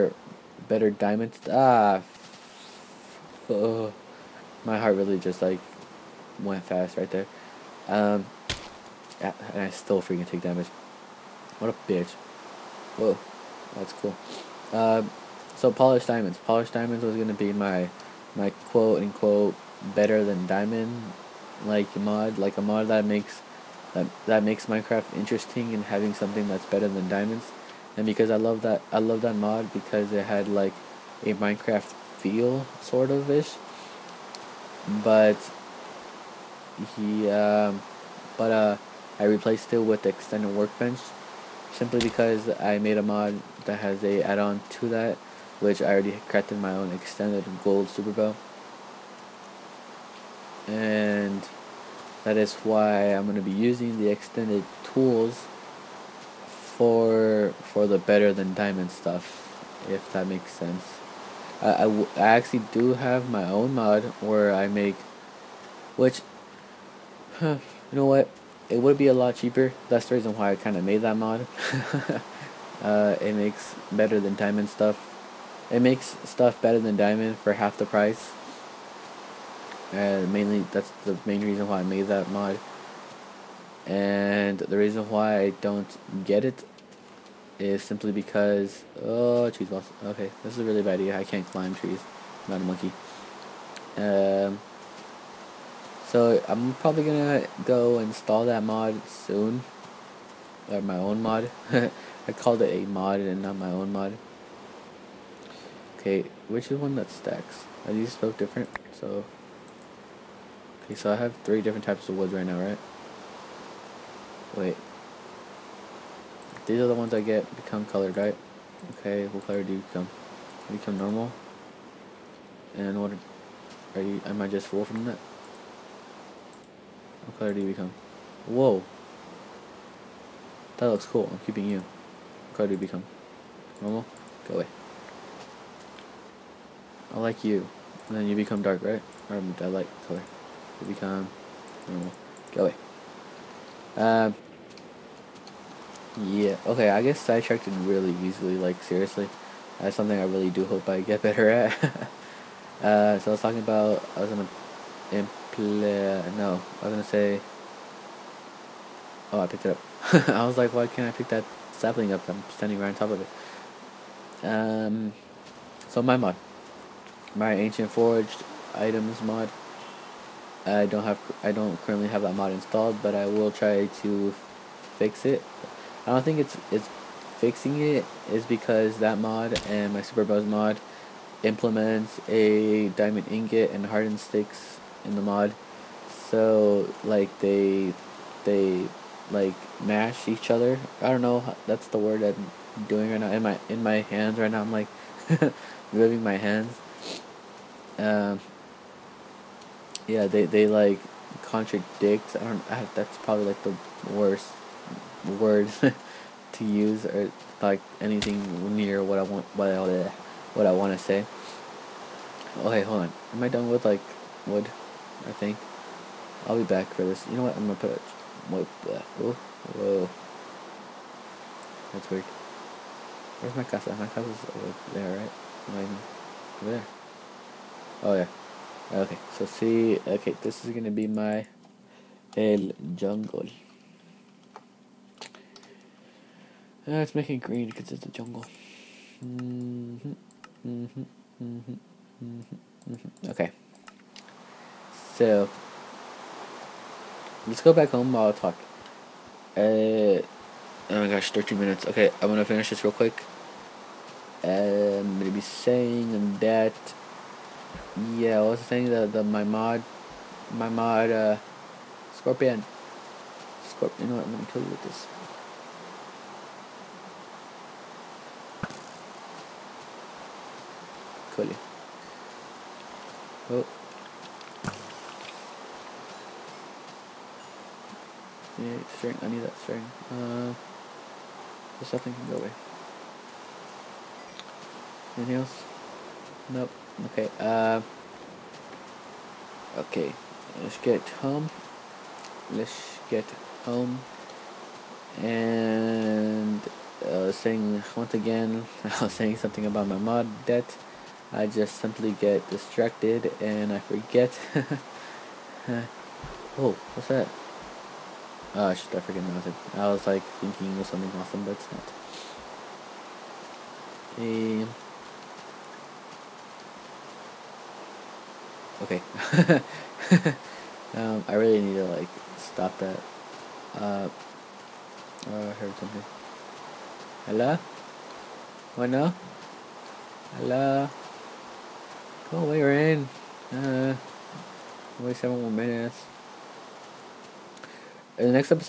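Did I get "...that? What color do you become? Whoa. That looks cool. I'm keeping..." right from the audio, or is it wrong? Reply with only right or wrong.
right.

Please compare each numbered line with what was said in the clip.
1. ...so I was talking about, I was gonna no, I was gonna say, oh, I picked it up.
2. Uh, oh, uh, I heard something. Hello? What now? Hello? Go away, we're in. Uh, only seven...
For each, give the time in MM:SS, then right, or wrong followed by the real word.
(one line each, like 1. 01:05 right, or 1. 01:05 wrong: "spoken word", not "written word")
1. 02:33 right
2. 05:23 right.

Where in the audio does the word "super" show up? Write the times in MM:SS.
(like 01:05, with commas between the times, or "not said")
00:47, 03:00.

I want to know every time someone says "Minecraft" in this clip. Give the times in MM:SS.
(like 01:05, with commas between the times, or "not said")
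00:24, 00:31.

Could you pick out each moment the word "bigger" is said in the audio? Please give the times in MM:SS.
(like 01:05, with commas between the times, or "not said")
not said.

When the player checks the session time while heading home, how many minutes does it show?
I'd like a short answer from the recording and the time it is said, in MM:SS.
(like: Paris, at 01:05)
13, at 04:11.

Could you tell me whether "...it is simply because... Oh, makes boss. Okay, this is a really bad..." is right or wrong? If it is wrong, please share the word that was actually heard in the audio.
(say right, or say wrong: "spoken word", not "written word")
wrong: "trees", not "makes".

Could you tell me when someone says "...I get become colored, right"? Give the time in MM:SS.
01:57.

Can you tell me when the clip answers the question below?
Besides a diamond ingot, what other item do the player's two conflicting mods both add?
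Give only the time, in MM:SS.
03:03.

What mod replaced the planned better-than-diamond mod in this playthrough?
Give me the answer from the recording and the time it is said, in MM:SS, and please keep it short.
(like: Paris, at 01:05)
Extended Workbench, at 00:40.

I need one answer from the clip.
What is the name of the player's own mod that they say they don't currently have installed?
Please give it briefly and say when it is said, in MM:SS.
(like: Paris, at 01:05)
Ancient Forged Items, at 02:47.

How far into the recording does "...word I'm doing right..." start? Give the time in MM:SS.
03:11.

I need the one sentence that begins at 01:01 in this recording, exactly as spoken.
I, I, actually do have my own mod where I make, which, huh, you know what, it would be a lot cheaper.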